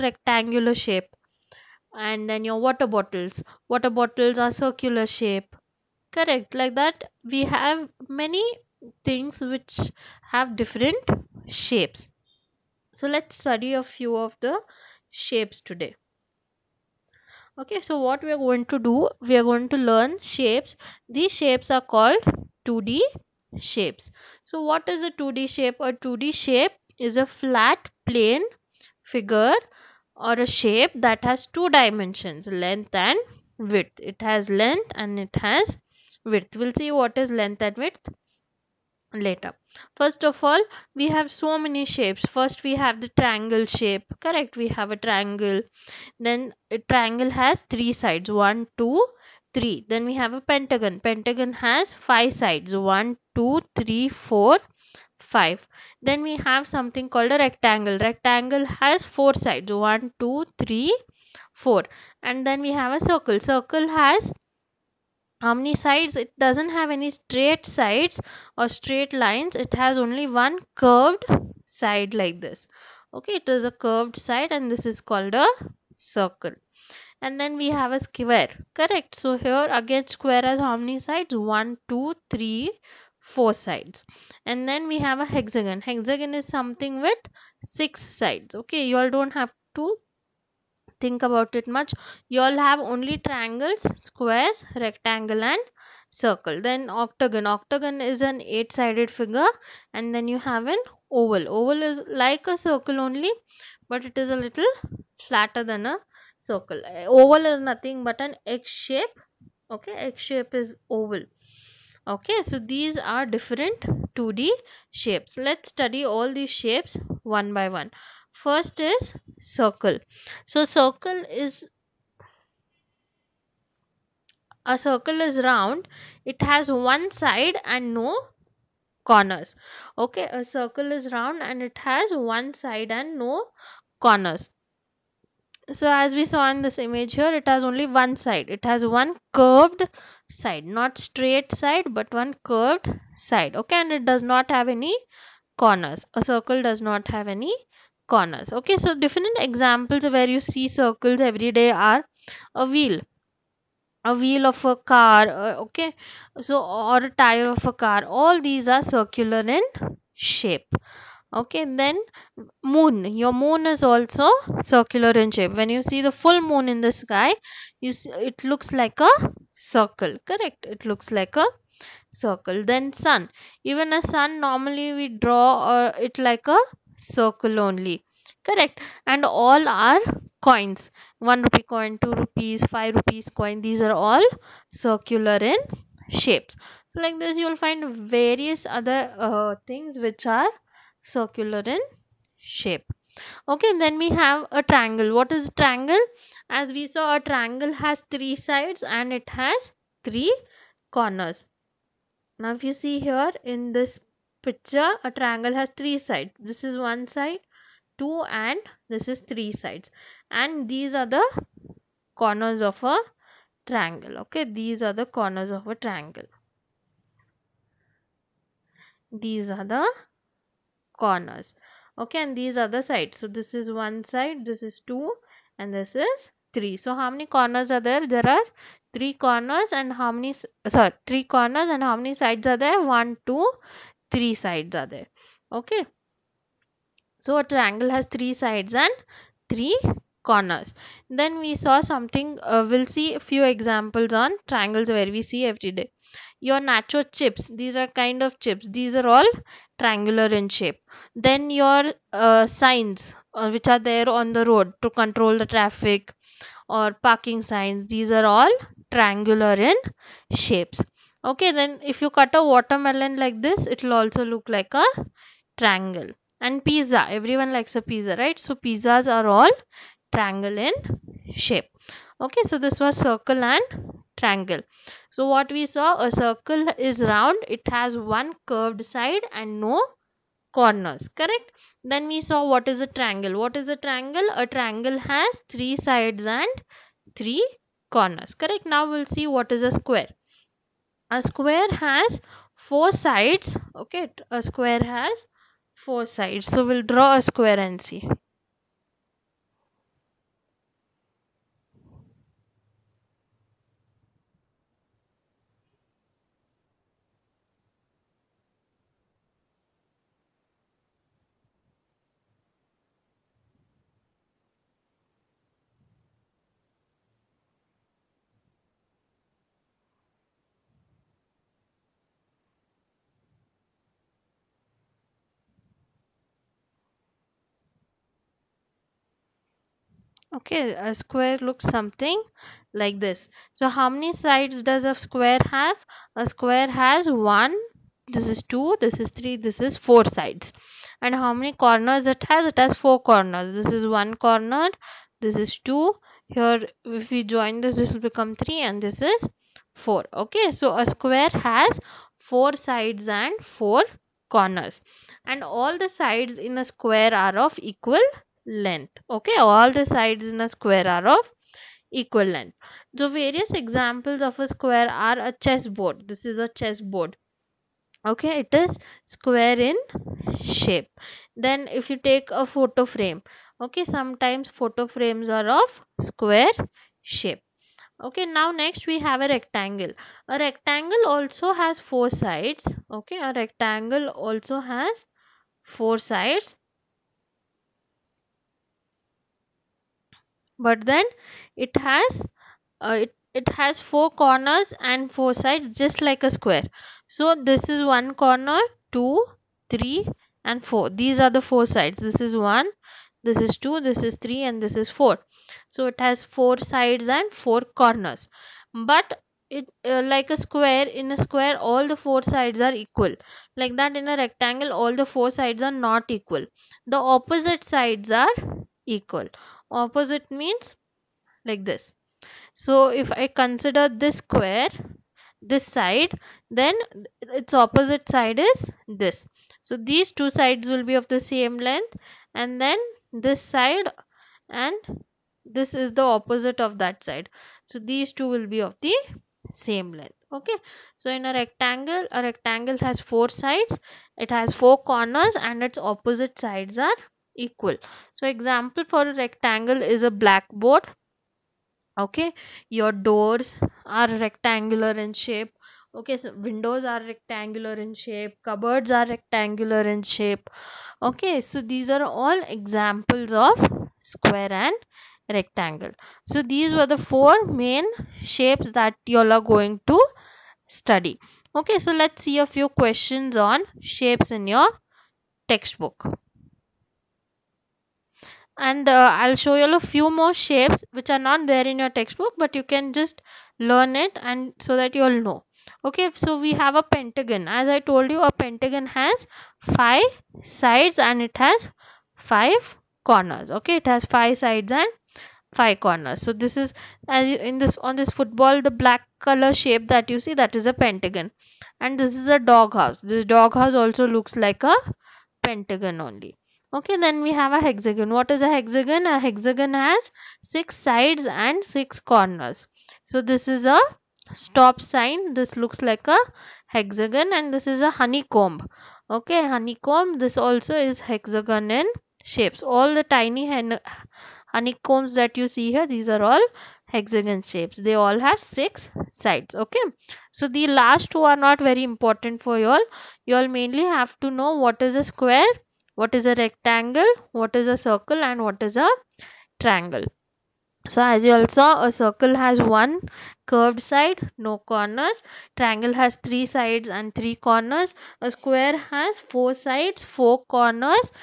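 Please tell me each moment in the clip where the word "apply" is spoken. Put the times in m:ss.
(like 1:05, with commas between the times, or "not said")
not said.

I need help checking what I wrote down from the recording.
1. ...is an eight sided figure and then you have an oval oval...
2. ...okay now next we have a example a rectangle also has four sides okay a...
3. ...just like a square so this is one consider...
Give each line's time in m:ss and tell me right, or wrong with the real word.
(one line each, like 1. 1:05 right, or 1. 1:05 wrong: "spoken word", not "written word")
1. 1:38 right
2. 6:18 wrong: "rectangle", not "example"
3. 6:35 wrong: "corner", not "consider".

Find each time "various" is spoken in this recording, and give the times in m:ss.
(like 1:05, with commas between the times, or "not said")
3:08, 6:03.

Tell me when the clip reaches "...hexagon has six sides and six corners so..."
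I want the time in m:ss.
8:29.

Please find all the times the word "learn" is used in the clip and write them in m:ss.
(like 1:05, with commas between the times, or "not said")
0:19, 8:03.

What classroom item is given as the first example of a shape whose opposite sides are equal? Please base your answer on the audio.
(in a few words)
blackboard.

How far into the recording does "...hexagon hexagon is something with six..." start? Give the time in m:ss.
1:25.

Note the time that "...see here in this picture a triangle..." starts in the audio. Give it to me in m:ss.
3:22.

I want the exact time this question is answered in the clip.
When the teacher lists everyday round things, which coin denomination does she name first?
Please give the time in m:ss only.
3:01.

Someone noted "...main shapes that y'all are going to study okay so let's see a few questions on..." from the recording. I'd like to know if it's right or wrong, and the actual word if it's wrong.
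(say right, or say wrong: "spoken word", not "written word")
right.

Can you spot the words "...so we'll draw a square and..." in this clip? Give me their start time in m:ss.
4:56.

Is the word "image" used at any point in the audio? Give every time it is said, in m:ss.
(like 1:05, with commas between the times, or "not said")
2:16.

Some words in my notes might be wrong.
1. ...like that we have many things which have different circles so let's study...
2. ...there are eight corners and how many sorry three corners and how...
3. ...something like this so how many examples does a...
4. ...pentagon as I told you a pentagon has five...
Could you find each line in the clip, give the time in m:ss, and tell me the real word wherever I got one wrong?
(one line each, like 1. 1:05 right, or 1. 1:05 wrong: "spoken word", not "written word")
1. 0:06 wrong: "shapes", not "circles"
2. 3:48 wrong: "three", not "eight"
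3. 5:31 wrong: "sides", not "examples"
4. 8:06 right.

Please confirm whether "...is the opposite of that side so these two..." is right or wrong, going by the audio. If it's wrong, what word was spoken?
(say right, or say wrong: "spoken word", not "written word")
right.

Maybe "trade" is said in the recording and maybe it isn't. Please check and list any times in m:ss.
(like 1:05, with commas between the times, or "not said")
not said.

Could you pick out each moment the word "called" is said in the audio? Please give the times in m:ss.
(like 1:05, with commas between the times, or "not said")
0:21, 0:57, 1:15.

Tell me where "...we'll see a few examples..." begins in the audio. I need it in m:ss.
4:02.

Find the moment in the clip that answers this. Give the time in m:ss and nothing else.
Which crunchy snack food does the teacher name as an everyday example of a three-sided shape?
4:06.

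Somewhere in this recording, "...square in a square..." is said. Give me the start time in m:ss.
6:50.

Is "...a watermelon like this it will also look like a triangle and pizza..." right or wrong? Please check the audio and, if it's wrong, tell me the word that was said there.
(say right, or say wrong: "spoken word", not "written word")
right.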